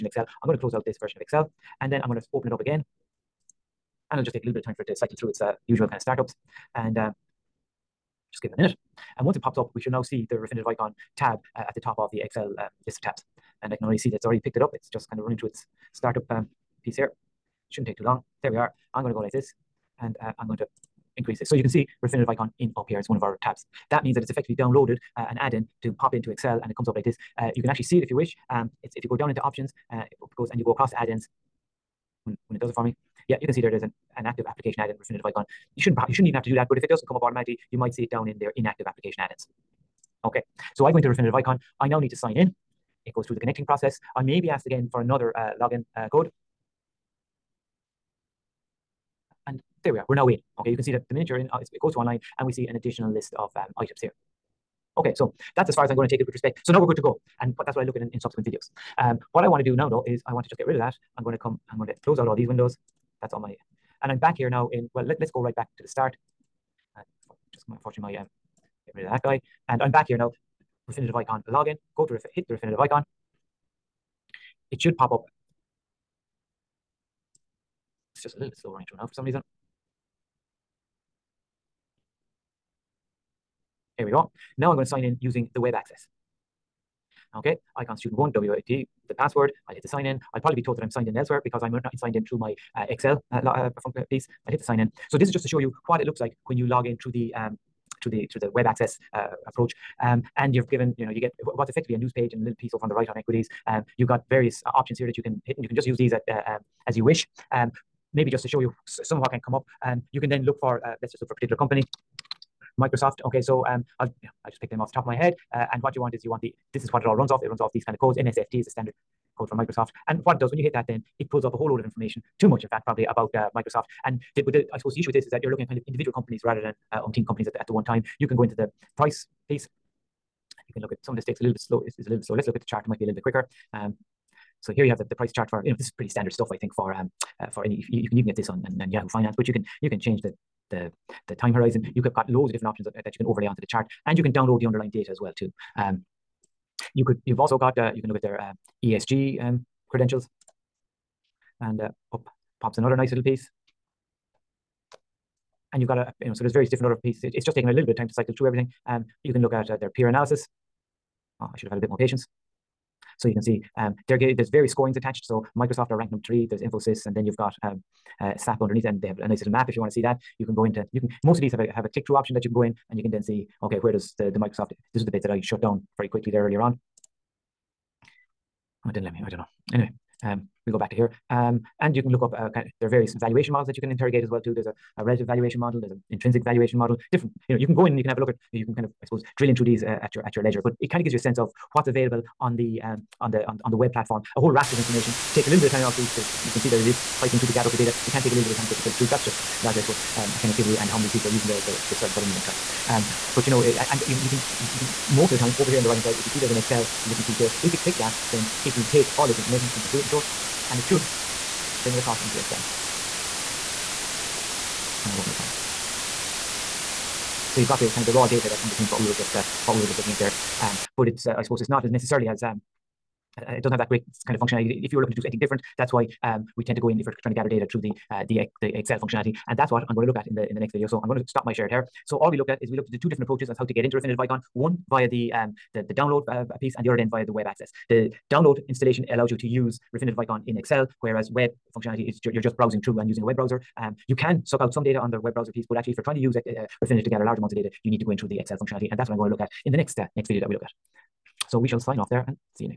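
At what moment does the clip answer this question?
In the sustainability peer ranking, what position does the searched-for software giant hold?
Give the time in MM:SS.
02:46.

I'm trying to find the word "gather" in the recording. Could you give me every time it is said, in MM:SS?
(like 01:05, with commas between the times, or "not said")
03:17, 03:47, 04:07.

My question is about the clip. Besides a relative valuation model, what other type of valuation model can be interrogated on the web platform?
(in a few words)
intrinsic valuation model.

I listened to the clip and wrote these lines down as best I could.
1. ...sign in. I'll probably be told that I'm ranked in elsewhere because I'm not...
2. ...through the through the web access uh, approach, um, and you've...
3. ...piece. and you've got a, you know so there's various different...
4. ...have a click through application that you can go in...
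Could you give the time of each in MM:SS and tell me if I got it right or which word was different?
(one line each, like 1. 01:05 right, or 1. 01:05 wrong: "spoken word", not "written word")
1. 01:29 wrong: "signed", not "ranked"
2. 01:38 right
3. 02:33 right
4. 02:51 wrong: "option", not "application".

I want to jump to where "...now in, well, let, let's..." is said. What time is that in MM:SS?
01:04.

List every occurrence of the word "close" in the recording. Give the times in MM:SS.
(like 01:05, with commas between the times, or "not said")
00:00, 01:02.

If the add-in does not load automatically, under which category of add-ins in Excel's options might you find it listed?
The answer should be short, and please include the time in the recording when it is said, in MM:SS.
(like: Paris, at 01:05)
inactive application add-ins, at 00:38.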